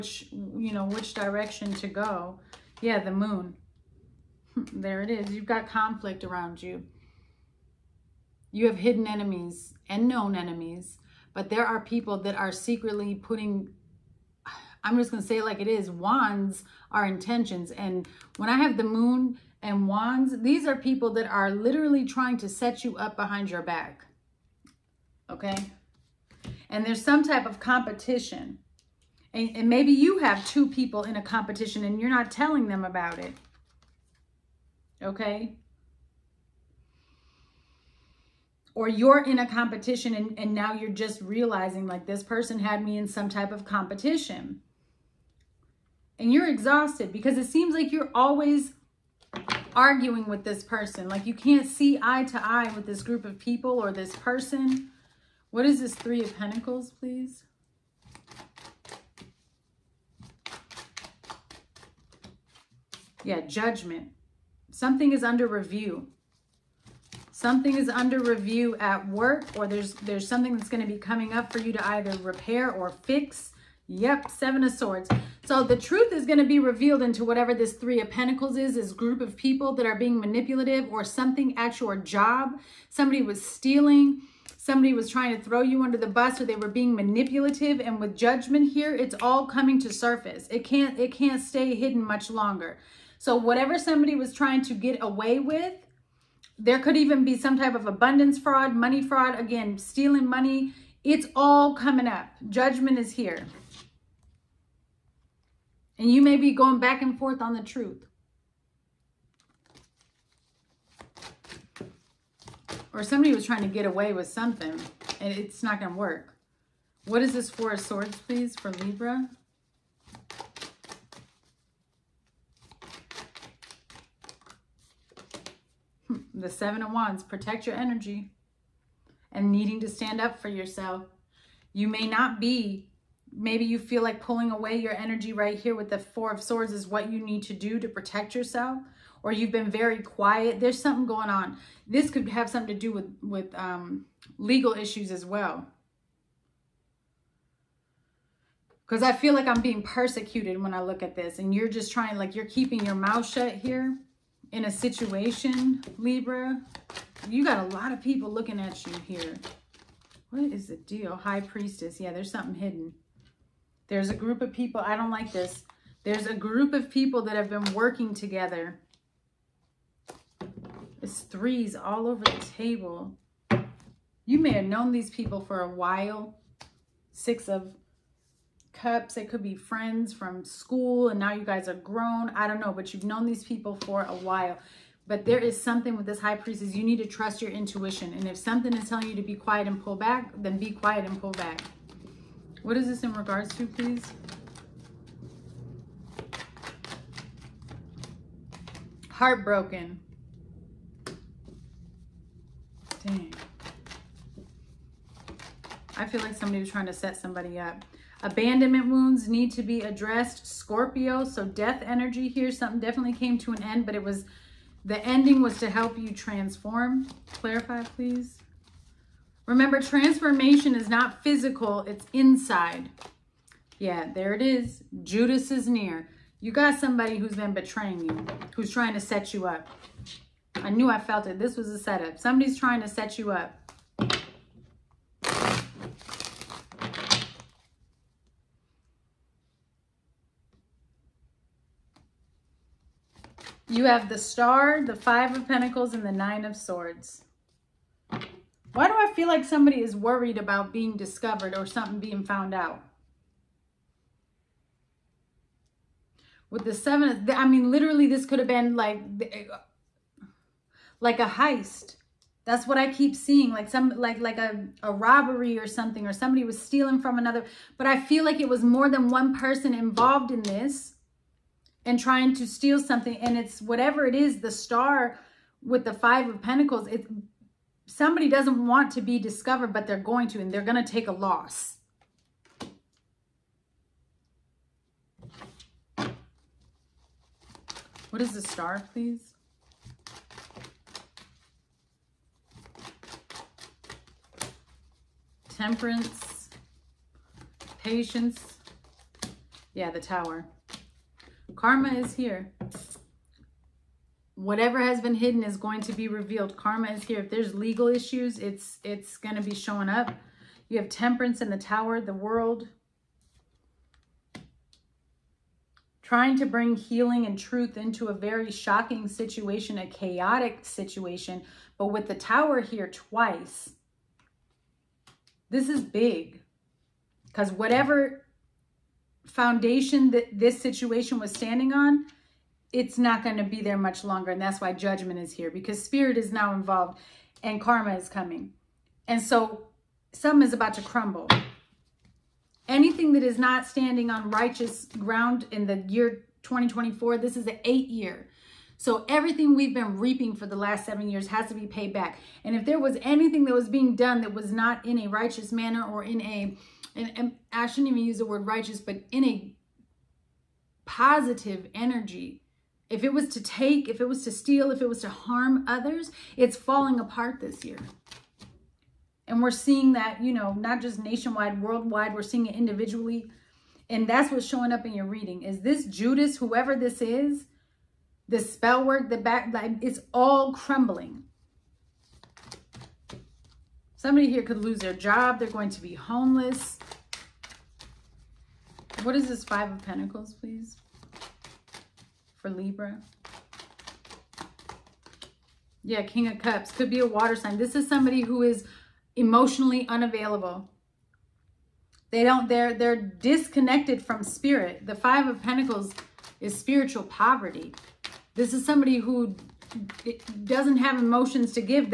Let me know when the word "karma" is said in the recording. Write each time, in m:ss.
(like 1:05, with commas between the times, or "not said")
5:01, 5:06, 5:37.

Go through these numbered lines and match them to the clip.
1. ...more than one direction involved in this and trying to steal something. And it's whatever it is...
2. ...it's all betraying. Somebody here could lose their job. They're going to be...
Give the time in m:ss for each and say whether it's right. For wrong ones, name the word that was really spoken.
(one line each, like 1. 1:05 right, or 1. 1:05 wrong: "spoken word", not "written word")
1. 4:28 wrong: "person", not "direction"
2. 6:19 wrong: "crumbling", not "betraying".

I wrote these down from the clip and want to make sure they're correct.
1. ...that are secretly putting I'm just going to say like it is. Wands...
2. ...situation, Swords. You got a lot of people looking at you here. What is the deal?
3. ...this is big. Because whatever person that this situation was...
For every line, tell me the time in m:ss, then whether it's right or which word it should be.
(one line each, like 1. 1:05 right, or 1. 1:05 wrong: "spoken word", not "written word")
1. 0:12 right
2. 2:34 wrong: "Libra", not "Swords"
3. 5:25 wrong: "foundation", not "person".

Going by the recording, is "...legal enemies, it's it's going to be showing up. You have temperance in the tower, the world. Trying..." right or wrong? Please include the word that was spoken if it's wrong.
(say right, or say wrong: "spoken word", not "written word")
wrong: "issues", not "enemies".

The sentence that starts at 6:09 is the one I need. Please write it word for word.
And we're seeing that, you know, not just nationwide, worldwide, we're seeing it individually.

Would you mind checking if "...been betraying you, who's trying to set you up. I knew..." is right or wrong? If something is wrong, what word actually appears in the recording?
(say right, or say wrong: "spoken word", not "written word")
right.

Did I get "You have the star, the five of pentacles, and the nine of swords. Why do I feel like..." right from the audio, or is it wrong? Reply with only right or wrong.
right.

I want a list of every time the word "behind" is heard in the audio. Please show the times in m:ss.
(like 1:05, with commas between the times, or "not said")
0:23.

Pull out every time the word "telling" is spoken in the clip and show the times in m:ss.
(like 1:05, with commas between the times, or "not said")
0:32, 3:08.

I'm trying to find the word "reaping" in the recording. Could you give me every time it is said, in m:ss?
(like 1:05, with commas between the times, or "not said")
5:49.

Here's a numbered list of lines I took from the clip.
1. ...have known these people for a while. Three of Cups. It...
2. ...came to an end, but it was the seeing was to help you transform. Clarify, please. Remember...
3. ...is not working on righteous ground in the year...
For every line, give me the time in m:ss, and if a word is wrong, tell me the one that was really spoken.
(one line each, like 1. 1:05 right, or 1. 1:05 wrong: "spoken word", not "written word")
1. 2:54 wrong: "Six", not "Three"
2. 3:33 wrong: "ending", not "seeing"
3. 5:43 wrong: "standing", not "working".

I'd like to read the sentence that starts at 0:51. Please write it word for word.
Like you can't see eye to eye with this group of people or this person.